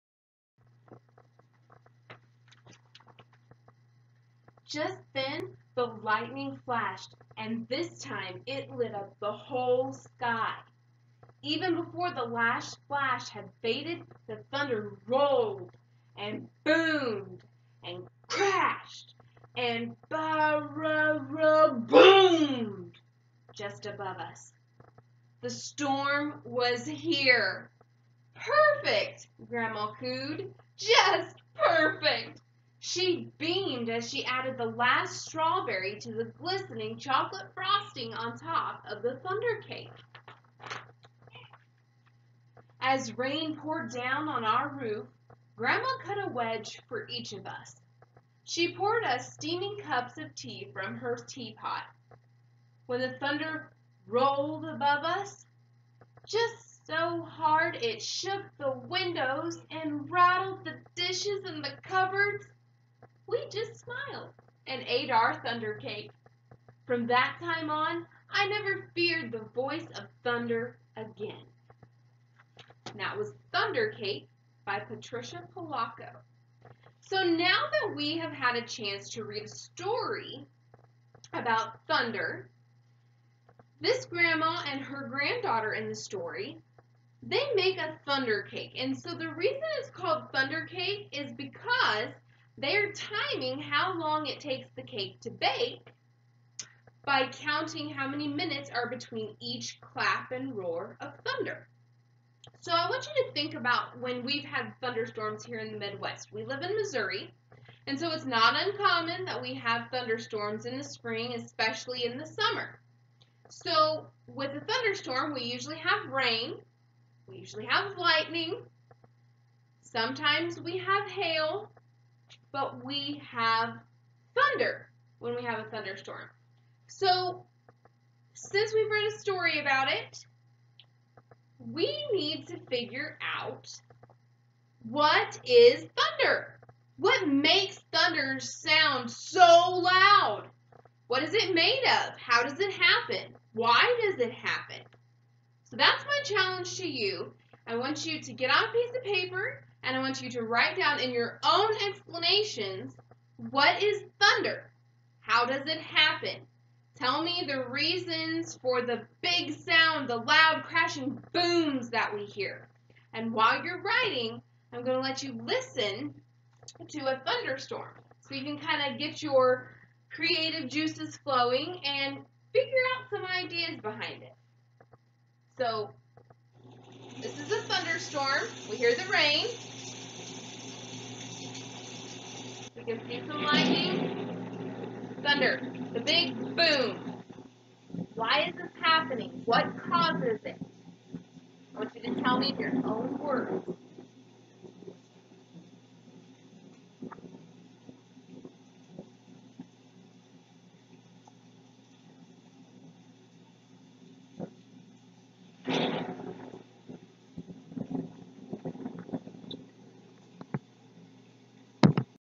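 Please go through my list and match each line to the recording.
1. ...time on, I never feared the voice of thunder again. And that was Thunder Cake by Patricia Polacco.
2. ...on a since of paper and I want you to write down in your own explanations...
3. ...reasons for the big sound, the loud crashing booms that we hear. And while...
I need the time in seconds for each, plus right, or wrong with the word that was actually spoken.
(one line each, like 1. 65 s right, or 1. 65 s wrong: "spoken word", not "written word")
1. 67 s right
2. 148 s wrong: "piece", not "since"
3. 157 s right.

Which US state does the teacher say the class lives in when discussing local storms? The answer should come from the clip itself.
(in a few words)
Missouri.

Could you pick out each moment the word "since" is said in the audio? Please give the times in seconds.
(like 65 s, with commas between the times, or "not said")
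128 s.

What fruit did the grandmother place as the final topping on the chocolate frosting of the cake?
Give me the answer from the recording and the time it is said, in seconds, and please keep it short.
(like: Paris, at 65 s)
strawberry, at 35 s.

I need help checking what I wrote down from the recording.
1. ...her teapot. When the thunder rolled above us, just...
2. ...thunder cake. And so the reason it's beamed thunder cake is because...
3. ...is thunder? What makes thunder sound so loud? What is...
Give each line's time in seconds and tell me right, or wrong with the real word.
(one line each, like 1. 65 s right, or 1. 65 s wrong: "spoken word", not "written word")
1. 50 s right
2. 88 s wrong: "called", not "beamed"
3. 135 s right.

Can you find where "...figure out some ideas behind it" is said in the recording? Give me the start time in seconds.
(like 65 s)
172 s.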